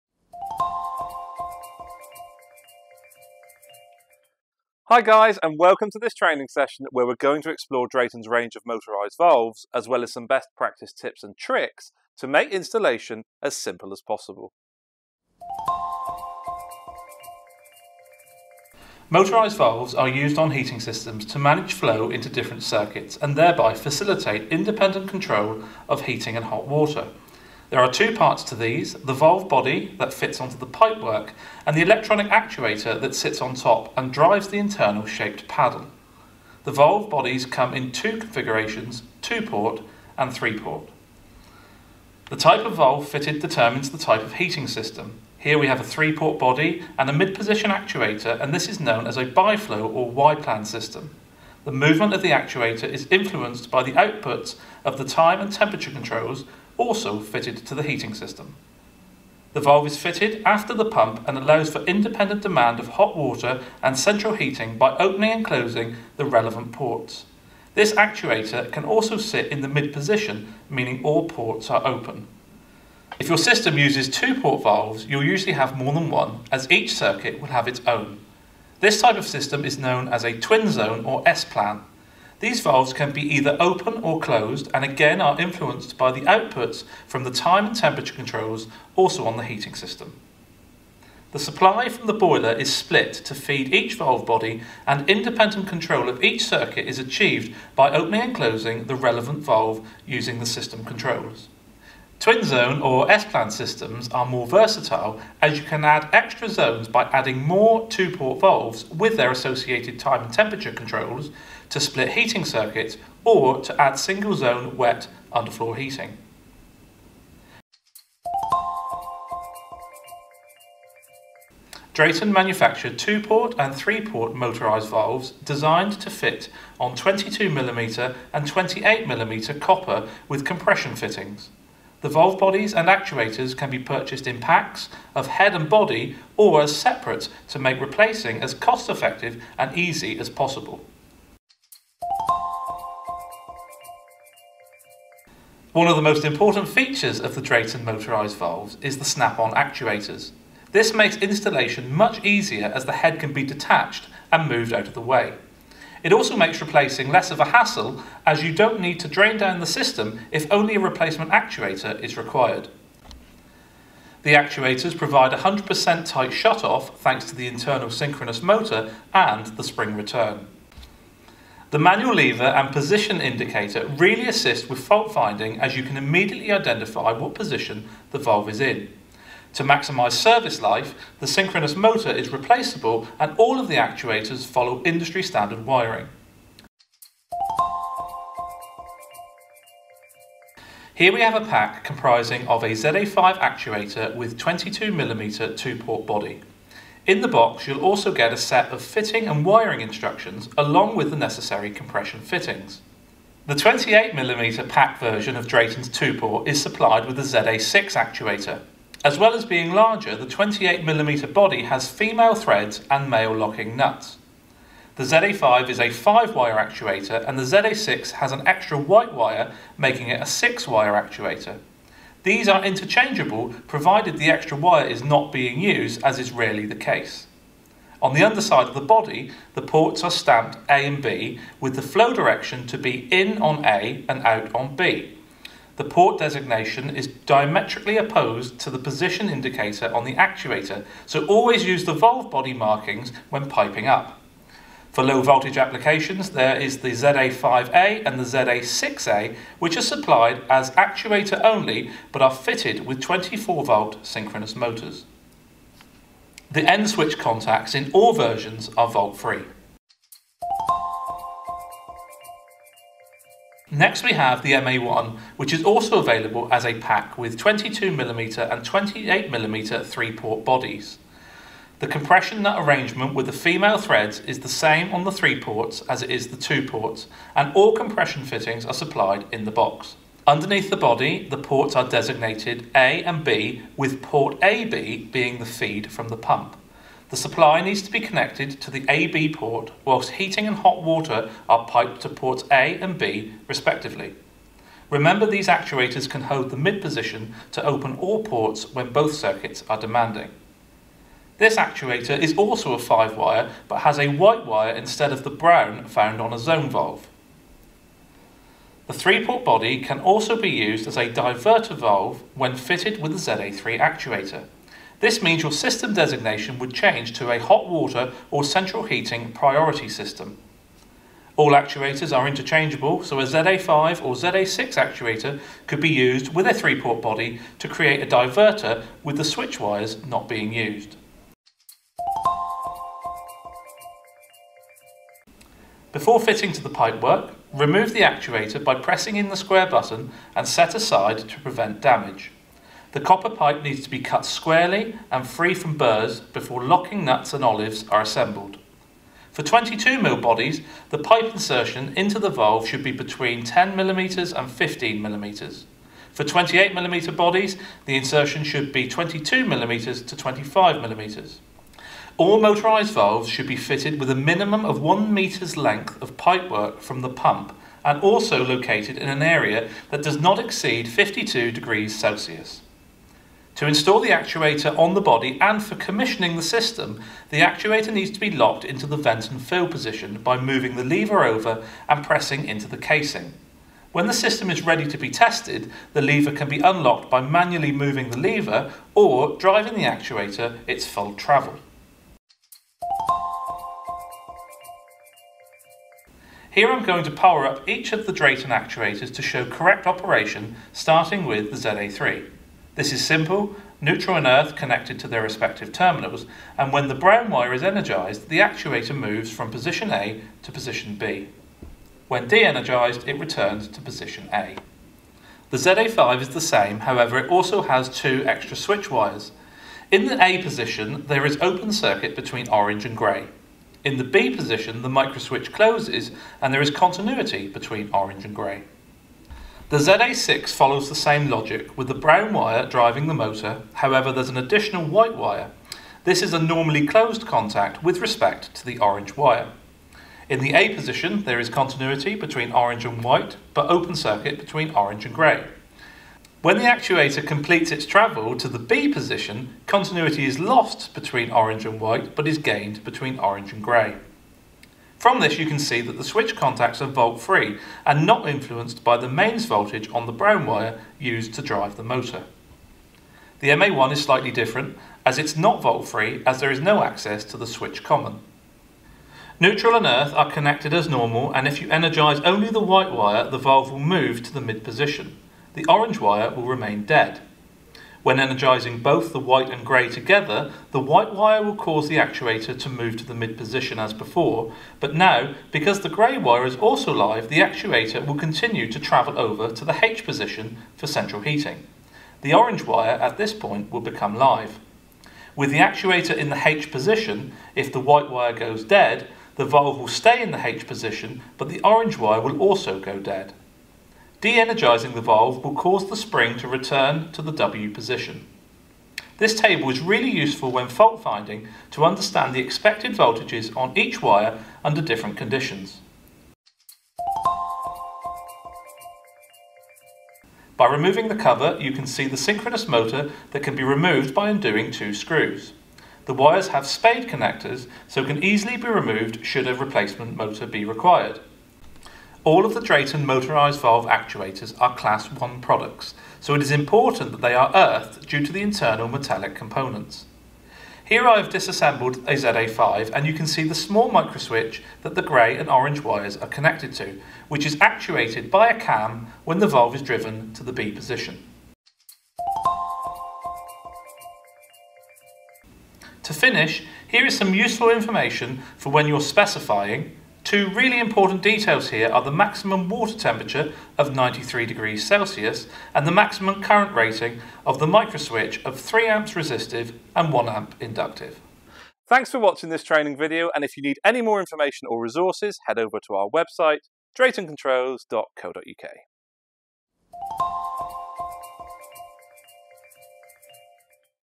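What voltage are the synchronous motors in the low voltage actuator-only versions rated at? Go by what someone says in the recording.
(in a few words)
24 volts.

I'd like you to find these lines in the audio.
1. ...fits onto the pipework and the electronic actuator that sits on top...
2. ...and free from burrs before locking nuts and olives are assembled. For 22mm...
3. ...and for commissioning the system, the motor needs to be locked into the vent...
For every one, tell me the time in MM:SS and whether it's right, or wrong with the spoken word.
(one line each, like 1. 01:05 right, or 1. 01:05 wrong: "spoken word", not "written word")
1. 00:30 right
2. 05:45 right
3. 06:15 wrong: "actuator", not "motor".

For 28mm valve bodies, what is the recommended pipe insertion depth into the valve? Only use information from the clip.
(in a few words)
22mm to 25mm.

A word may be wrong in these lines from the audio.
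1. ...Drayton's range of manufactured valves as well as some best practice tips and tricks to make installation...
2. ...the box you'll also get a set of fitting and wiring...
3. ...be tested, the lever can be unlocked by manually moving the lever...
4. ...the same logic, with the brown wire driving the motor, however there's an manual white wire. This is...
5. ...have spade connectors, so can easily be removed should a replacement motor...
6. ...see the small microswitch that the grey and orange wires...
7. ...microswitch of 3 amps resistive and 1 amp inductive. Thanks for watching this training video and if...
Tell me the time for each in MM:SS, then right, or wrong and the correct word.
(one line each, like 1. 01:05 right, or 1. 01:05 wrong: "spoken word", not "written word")
1. 00:07 wrong: "motorised", not "manufactured"
2. 03:17 right
3. 06:24 right
4. 07:10 wrong: "additional", not "manual"
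5. 08:46 right
6. 09:03 right
7. 09:27 right.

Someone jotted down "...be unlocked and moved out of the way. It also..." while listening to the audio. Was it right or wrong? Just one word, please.
wrong.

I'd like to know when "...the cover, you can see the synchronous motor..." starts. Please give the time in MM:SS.
08:41.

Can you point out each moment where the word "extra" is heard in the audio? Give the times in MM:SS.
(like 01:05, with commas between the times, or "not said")
01:46, 03:38, 03:44, 06:58.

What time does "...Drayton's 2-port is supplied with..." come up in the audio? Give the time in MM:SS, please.
03:25.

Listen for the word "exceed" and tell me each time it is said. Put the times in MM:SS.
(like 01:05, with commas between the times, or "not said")
06:10.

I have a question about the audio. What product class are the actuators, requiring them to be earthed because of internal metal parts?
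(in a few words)
Class 1.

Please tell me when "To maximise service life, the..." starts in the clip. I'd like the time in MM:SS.
02:59.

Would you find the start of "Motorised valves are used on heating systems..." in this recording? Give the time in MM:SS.
00:19.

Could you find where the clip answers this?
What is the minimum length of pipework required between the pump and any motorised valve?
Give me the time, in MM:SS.
06:04.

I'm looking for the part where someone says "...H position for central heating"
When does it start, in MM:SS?
08:09.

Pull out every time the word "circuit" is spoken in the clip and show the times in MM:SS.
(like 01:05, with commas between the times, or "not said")
00:22, 01:16, 01:36, 01:52, 04:59, 07:01, 07:23.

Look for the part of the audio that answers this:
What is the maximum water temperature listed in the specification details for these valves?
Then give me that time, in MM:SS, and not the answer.
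09:23.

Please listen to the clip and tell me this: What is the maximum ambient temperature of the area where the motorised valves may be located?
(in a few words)
52 degrees Celsius.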